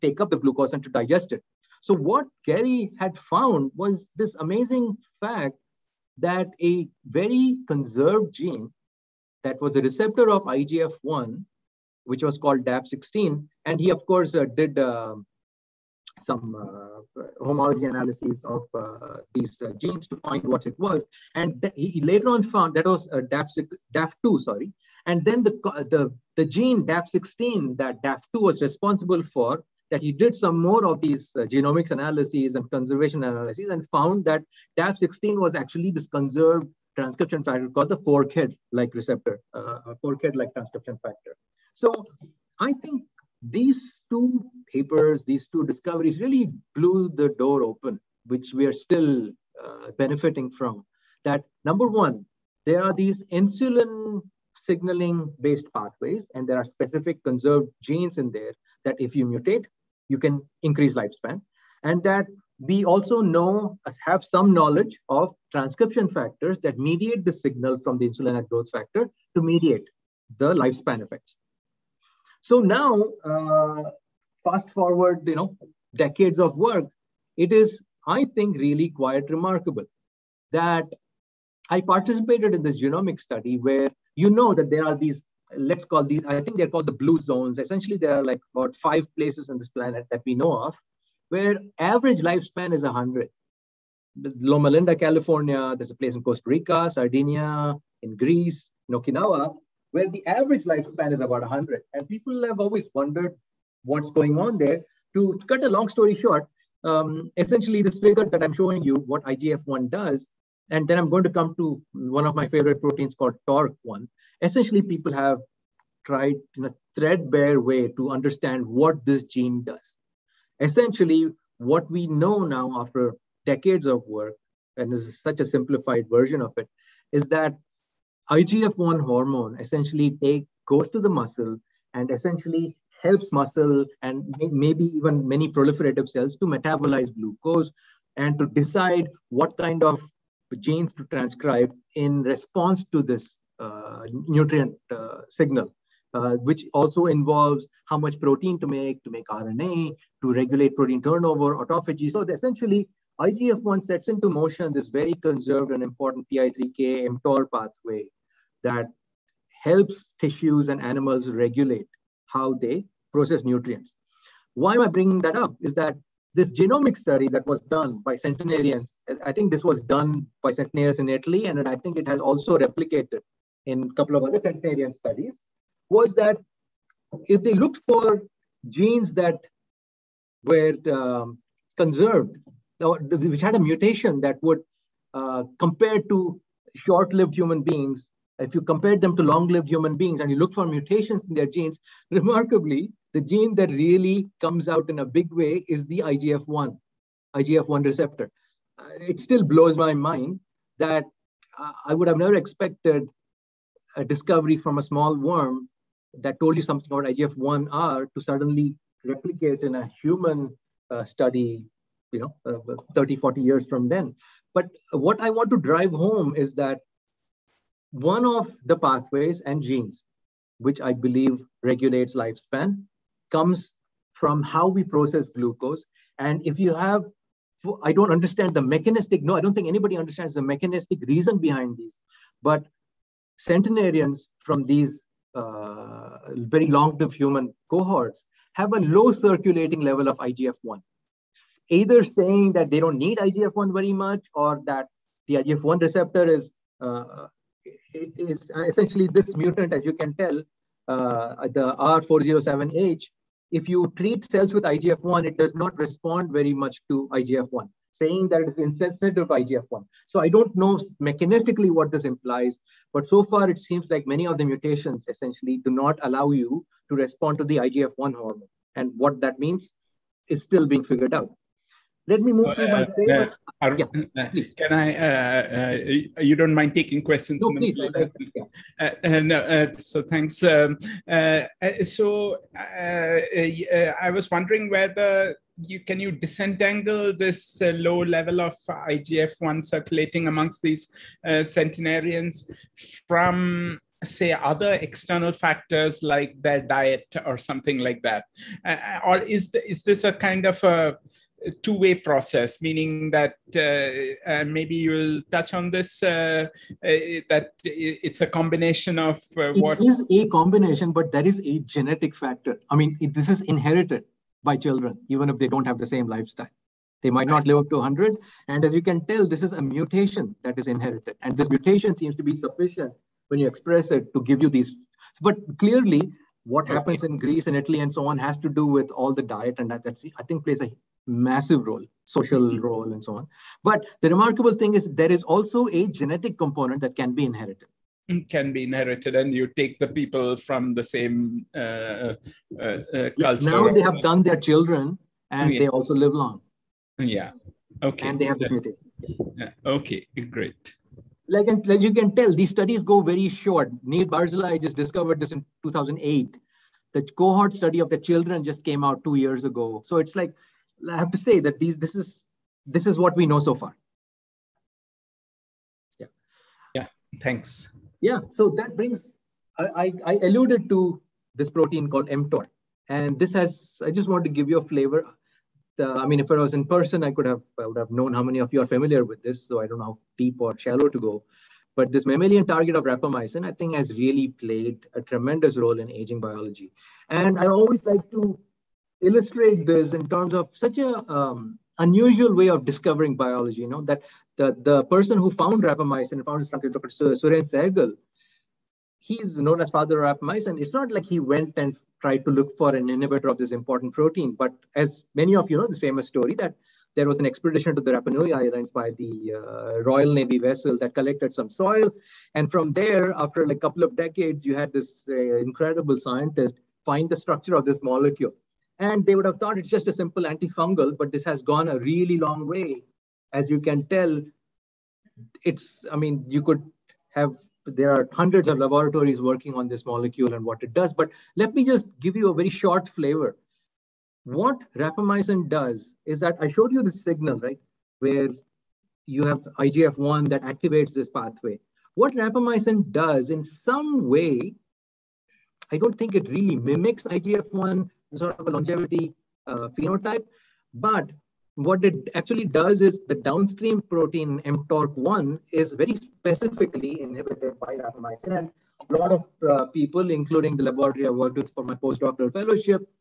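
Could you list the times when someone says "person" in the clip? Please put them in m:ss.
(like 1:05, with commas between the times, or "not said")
6:16, 6:34.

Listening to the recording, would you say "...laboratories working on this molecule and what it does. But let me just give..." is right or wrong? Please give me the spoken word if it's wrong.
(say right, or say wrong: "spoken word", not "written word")
right.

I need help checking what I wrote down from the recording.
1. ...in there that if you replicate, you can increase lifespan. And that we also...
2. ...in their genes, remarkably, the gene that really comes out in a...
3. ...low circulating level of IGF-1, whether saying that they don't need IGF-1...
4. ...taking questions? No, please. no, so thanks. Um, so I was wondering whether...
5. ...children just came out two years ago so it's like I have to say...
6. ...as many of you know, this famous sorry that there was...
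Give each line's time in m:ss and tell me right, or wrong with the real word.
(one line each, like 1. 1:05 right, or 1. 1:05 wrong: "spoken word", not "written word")
1. 0:58 wrong: "mutate", not "replicate"
2. 3:11 right
3. 3:58 wrong: "either", not "whether"
4. 4:36 right
5. 5:57 right
6. 6:44 wrong: "story", not "sorry".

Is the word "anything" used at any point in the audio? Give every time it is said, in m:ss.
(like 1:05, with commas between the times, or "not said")
not said.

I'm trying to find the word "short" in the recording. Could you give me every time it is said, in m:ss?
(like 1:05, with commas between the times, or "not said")
1:46, 3:06, 5:53, 7:12.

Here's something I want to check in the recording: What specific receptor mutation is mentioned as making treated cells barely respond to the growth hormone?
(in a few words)
R407H.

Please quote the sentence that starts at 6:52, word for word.
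And from there, after like a couple of decades, you had this uh, incredible scientist find the structure of this molecule.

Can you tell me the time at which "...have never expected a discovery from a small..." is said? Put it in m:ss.
3:22.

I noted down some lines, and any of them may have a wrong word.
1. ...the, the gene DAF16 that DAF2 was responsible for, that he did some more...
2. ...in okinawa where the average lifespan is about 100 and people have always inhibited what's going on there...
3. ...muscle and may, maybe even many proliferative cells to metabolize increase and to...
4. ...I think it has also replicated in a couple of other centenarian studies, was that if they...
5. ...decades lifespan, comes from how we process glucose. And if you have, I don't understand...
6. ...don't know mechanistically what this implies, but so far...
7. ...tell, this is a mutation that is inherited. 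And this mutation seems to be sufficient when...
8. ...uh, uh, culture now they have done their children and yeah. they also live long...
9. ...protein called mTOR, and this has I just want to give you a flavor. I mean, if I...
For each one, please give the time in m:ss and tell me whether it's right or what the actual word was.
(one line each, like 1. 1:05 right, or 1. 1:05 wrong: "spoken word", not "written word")
1. 0:25 right
2. 1:38 wrong: "wondered", not "inhibited"
3. 2:13 wrong: "glucose", not "increase"
4. 2:51 right
5. 3:41 wrong: "regulates", not "decades"
6. 4:20 right
7. 5:19 right
8. 5:41 right
9. 6:11 right.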